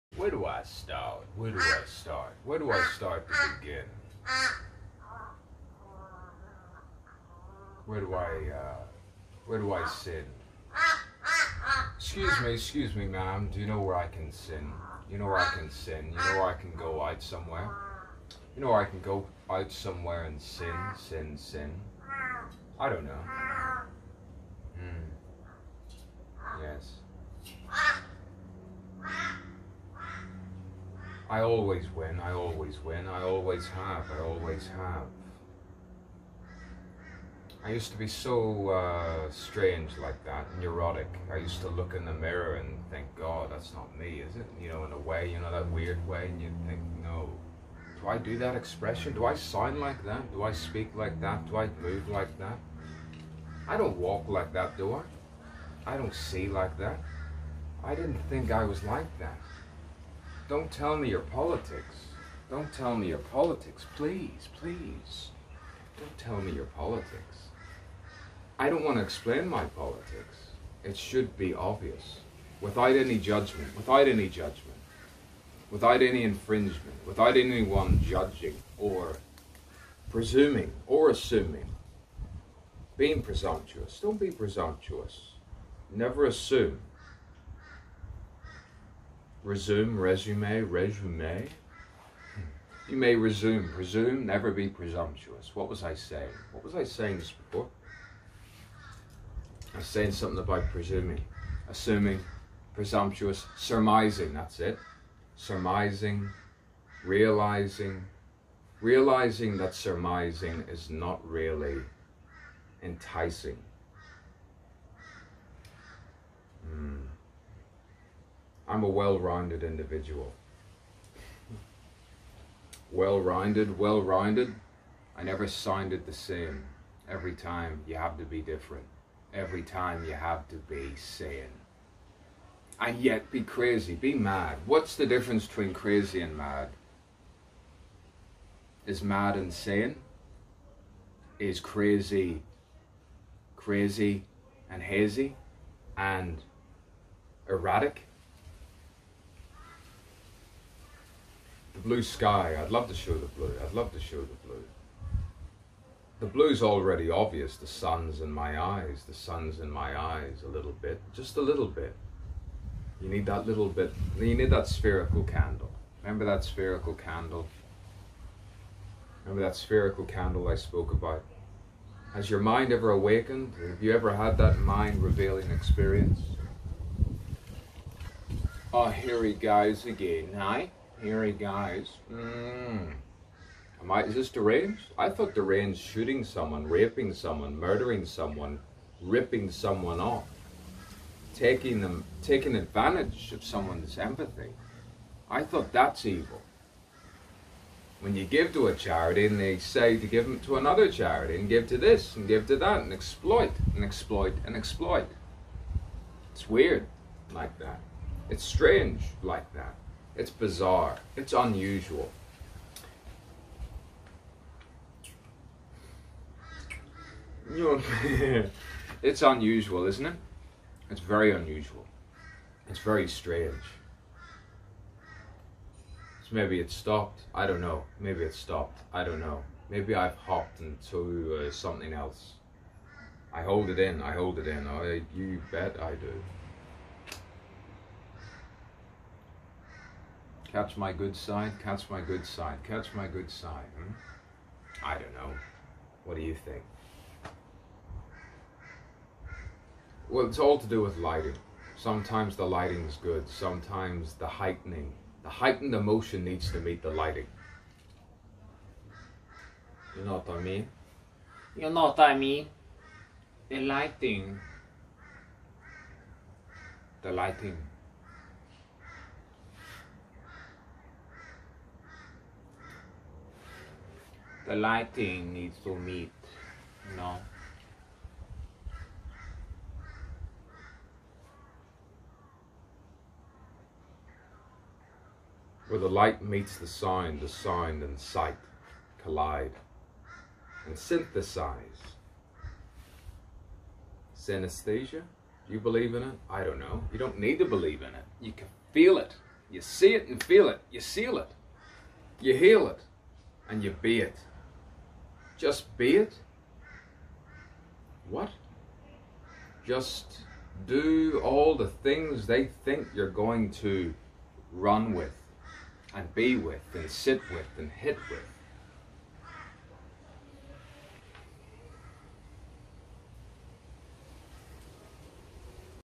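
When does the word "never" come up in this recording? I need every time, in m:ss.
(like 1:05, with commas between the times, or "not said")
1:25, 1:34, 2:05.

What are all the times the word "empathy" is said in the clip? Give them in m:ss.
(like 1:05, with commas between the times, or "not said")
3:13.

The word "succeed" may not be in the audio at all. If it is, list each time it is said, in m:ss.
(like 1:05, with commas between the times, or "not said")
not said.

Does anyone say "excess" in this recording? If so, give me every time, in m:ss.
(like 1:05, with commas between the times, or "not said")
not said.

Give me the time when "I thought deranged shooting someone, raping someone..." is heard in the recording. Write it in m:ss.
3:04.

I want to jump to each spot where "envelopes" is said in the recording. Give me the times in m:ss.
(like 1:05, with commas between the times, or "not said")
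not said.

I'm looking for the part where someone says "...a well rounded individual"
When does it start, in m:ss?
1:58.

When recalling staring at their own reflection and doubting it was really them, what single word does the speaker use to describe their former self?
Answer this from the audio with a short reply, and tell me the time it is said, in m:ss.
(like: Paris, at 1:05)
neurotic, at 0:40.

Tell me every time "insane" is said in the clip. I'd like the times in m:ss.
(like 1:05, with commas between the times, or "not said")
2:19.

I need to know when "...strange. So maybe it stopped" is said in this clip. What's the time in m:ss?
3:43.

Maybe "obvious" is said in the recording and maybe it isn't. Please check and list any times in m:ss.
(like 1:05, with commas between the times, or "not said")
1:11, 2:37.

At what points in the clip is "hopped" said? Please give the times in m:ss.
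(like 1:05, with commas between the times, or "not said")
3:50.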